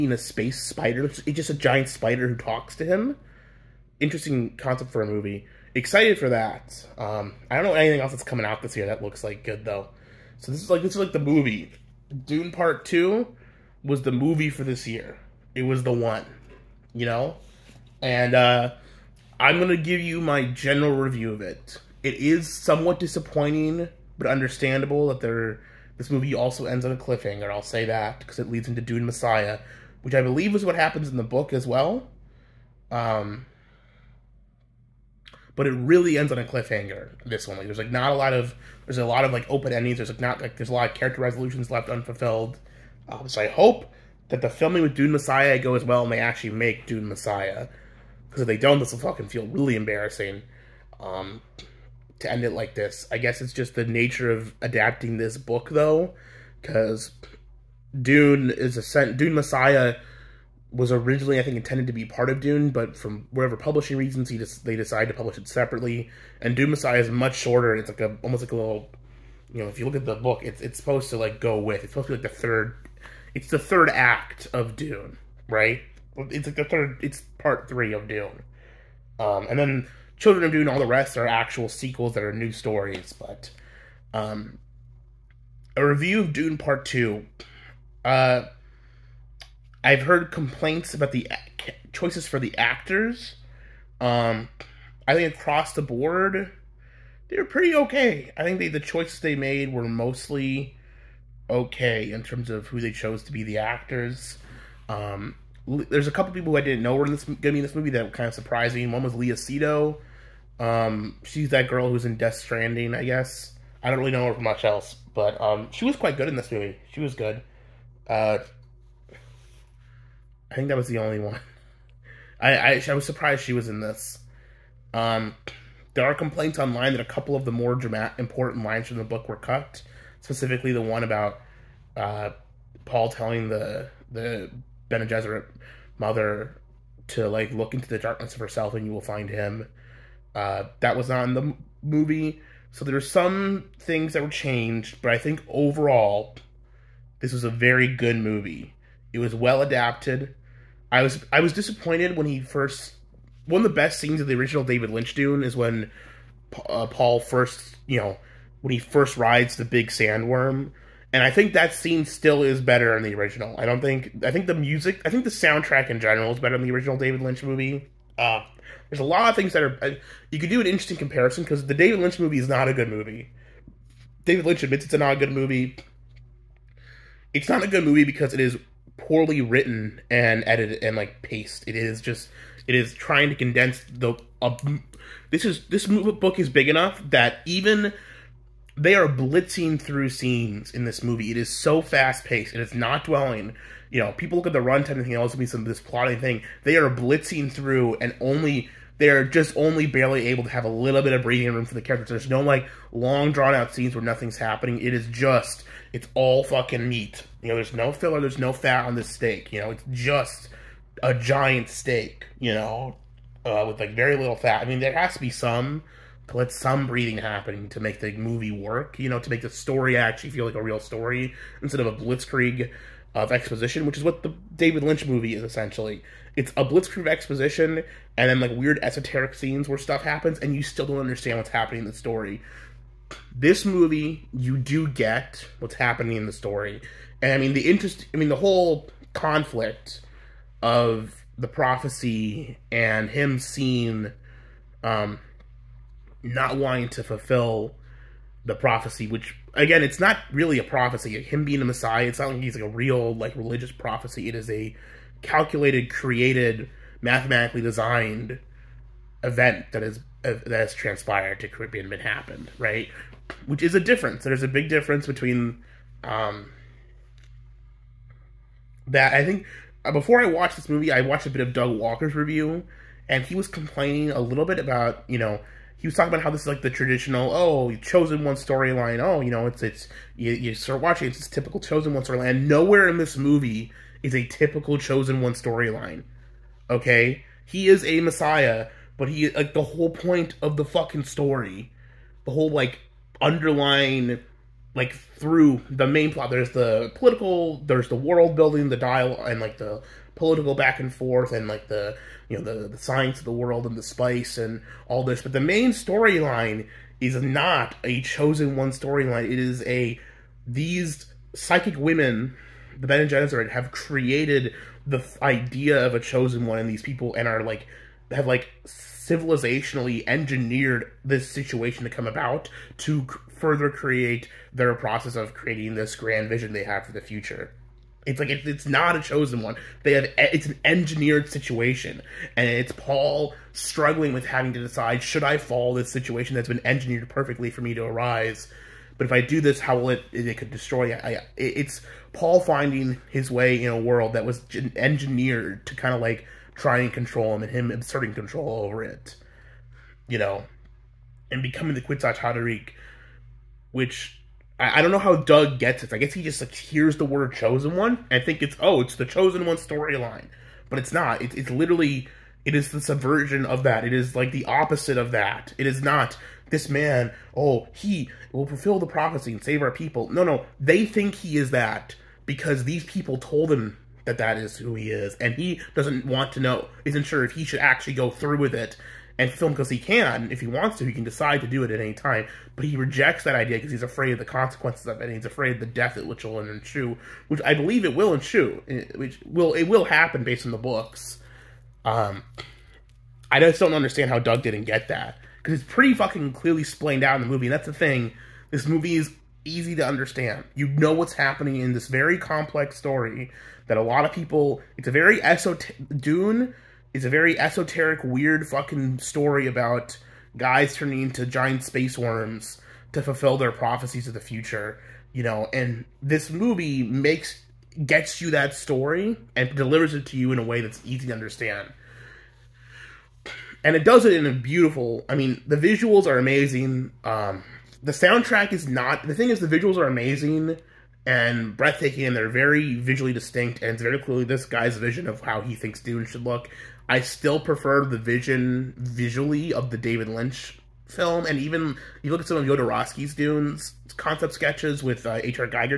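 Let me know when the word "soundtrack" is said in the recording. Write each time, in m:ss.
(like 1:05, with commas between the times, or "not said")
2:45, 7:07.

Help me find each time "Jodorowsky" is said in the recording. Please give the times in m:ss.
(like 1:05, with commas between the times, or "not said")
7:22.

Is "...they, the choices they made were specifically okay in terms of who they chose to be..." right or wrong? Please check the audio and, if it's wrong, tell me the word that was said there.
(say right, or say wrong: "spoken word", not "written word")
wrong: "mostly", not "specifically".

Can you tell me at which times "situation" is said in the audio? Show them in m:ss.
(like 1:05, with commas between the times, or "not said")
5:21, 5:31, 5:35.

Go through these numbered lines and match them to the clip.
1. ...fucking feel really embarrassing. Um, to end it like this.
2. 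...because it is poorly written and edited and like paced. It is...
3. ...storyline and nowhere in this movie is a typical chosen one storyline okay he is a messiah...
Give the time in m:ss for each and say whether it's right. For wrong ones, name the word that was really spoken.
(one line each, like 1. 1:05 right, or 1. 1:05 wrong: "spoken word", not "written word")
1. 0:48 right
2. 2:58 right
3. 4:42 right.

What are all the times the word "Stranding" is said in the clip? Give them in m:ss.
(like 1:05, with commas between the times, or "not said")
1:52.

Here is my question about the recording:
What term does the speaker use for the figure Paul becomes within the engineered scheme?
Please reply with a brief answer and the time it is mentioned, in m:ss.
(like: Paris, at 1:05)
Kwisatz Haderach, at 5:51.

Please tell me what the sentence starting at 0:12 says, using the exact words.
Dune Part Two was the movie for this year.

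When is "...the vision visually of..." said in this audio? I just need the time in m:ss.
7:17.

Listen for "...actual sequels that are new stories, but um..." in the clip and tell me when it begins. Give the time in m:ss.
1:21.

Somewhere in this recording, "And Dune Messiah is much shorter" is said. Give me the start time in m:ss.
1:06.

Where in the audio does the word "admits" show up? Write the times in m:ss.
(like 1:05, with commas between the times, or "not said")
2:54.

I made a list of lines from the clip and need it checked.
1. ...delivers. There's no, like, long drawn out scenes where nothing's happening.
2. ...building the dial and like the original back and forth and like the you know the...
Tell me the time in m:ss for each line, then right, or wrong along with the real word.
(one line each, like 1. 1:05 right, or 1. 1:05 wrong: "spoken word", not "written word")
1. 3:21 wrong: "characters", not "delivers"
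2. 4:58 wrong: "political", not "original".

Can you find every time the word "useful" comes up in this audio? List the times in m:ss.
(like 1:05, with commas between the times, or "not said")
not said.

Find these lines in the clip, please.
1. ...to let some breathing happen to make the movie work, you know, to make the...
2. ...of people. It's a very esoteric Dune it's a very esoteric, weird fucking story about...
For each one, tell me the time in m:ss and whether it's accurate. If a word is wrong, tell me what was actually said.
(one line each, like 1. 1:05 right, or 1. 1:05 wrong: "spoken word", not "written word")
1. 3:36 right
2. 6:44 right.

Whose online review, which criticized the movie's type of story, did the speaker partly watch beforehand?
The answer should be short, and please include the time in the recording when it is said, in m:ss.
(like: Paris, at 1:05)
Doug Walker, at 4:31.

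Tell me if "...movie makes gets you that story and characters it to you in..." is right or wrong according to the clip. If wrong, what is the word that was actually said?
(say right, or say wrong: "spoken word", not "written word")
wrong: "delivers", not "characters".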